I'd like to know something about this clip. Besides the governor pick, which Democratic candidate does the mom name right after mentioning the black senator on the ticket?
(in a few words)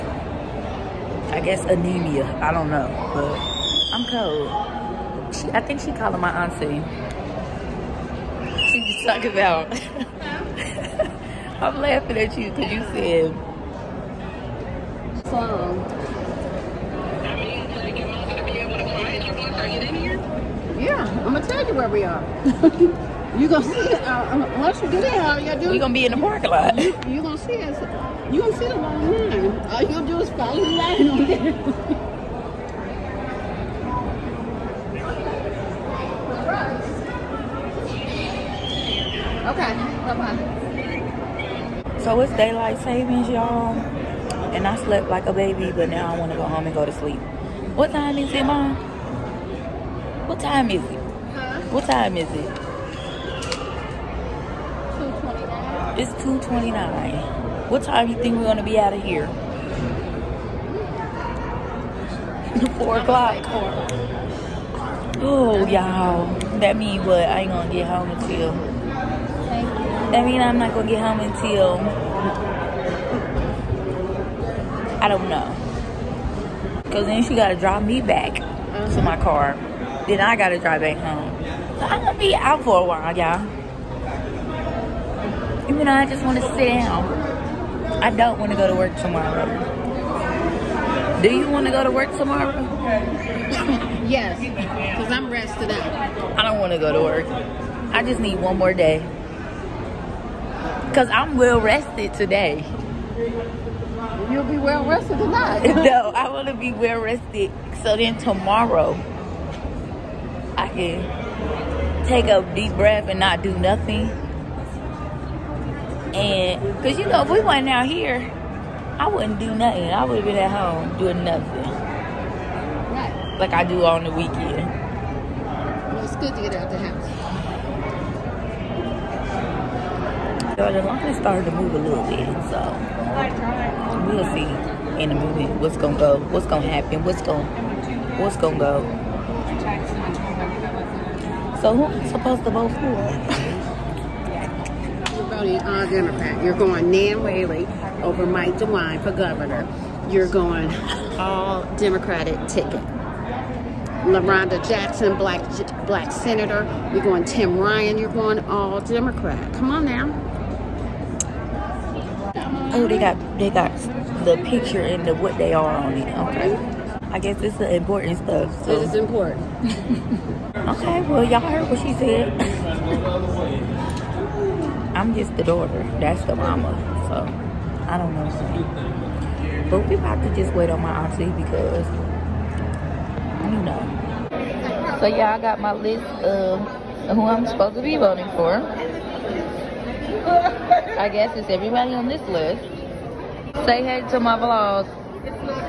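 Tim Ryan.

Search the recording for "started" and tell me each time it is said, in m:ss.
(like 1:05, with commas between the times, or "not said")
2:11.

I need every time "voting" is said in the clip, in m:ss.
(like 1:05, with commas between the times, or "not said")
2:25, 3:07.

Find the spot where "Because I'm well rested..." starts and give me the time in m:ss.
1:40.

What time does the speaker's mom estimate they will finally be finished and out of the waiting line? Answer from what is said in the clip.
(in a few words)
4 o'clock.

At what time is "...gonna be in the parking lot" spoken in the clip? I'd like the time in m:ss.
0:25.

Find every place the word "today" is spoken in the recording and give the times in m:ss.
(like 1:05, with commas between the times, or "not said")
1:42.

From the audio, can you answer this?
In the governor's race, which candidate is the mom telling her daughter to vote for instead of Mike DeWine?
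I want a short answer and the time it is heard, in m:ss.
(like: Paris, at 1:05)
Nan Whaley, at 2:26.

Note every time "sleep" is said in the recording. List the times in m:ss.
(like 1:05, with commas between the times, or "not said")
0:46.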